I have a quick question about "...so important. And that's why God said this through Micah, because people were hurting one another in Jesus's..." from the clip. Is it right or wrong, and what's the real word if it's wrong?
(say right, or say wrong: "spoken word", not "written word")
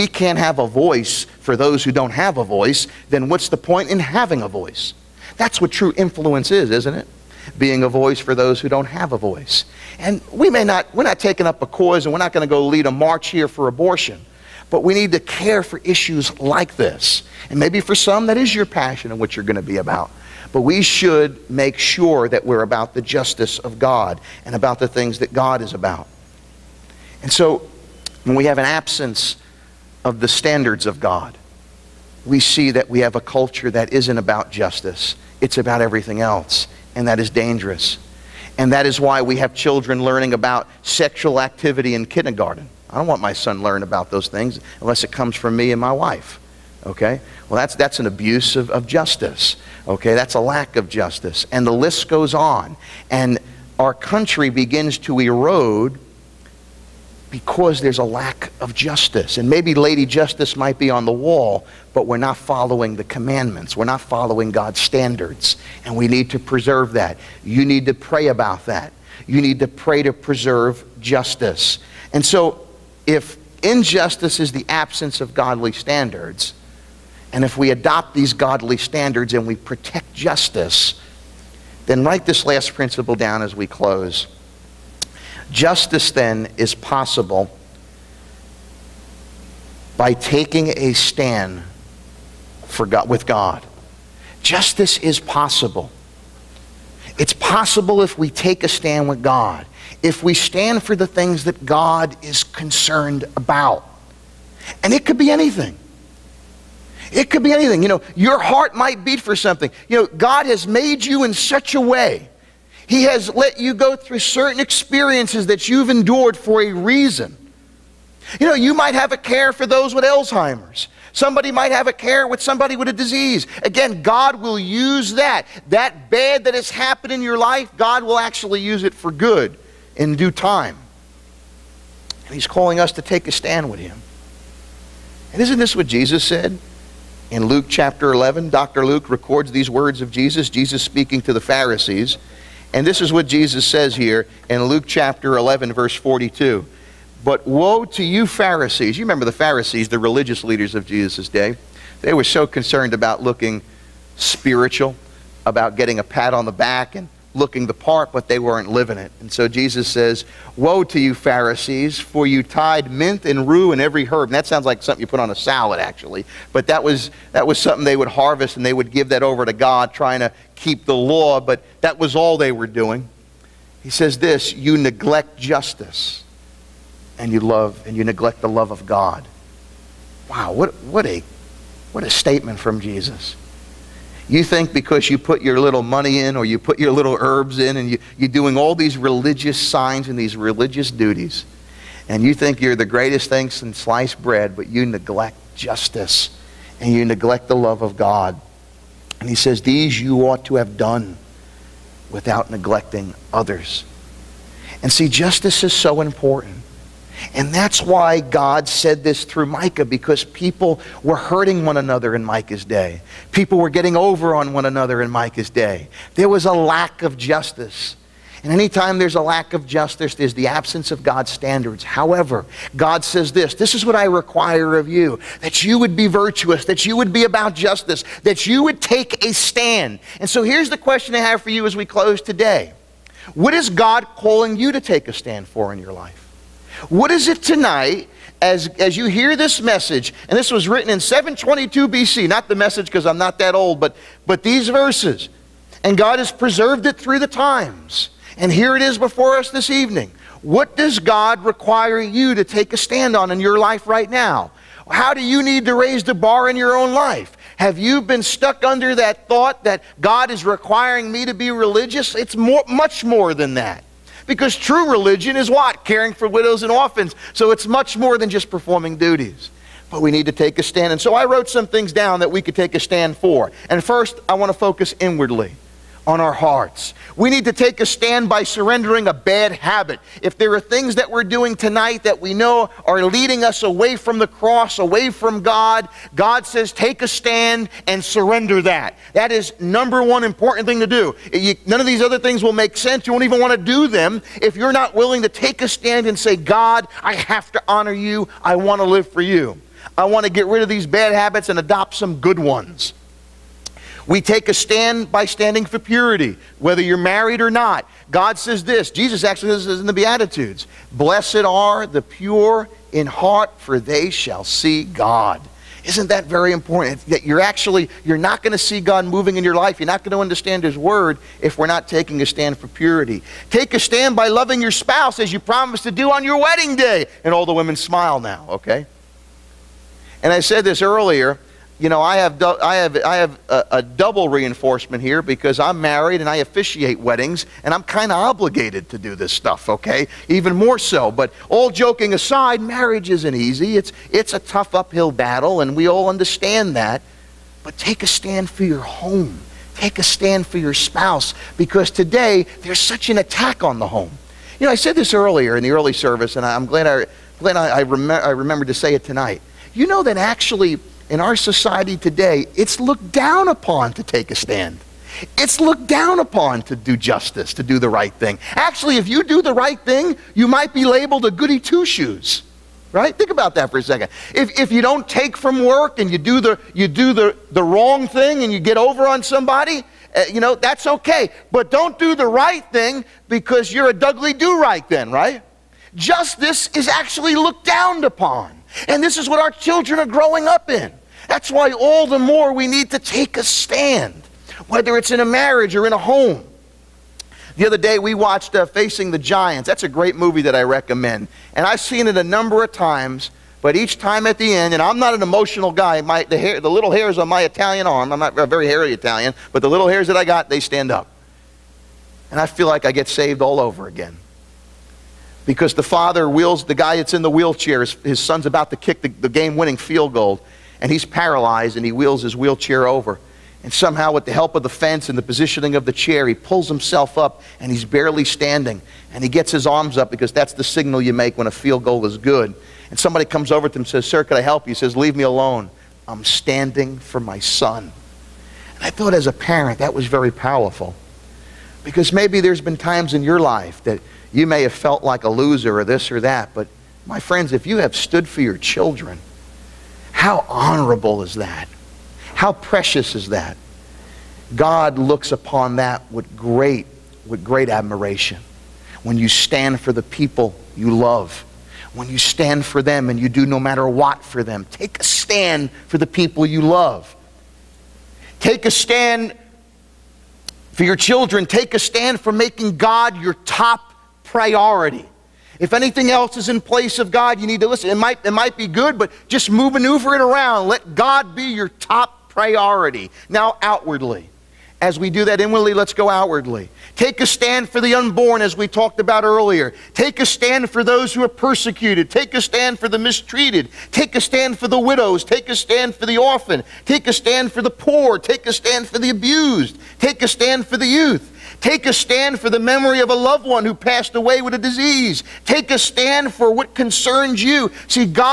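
wrong: "Micah", not "Jesus".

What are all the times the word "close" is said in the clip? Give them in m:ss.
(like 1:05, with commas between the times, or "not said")
1:23, 3:51.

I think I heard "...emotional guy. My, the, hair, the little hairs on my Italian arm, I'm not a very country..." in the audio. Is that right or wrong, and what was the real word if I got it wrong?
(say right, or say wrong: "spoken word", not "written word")
wrong: "hairy", not "country".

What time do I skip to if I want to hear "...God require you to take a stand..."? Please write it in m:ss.
4:10.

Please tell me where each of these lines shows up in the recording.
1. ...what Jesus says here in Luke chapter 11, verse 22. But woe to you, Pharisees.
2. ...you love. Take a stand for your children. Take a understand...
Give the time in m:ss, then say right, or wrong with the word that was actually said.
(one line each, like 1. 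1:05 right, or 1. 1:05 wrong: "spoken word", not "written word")
1. 2:23 wrong: "42", not "22"
2. 7:46 wrong: "stand", not "understand".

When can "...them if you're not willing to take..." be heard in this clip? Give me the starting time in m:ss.
4:53.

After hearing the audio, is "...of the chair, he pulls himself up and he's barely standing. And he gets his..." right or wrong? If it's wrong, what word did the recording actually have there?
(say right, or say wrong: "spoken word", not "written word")
right.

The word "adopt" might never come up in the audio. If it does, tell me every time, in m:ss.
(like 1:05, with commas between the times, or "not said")
1:17, 5:01.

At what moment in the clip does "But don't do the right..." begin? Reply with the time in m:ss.
6:21.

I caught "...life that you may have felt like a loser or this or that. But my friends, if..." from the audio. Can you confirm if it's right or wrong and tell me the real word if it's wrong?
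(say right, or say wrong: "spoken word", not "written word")
right.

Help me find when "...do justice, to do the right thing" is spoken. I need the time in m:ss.
6:06.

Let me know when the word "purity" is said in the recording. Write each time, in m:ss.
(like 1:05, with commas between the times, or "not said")
5:05, 5:22.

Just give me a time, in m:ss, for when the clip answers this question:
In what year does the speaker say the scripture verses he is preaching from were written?
4:00.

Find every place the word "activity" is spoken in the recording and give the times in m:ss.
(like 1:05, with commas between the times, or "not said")
0:41.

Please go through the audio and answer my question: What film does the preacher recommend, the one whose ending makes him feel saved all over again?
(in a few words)
Facing the Giants.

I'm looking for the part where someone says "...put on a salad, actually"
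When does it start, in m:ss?
2:45.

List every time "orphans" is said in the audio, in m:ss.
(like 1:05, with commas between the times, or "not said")
4:26, 8:16.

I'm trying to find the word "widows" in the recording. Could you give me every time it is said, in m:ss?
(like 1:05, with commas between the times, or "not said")
4:26, 8:14.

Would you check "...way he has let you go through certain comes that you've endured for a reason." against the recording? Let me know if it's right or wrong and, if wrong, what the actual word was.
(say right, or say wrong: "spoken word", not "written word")
wrong: "experiences", not "comes".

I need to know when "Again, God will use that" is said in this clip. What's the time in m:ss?
2:03.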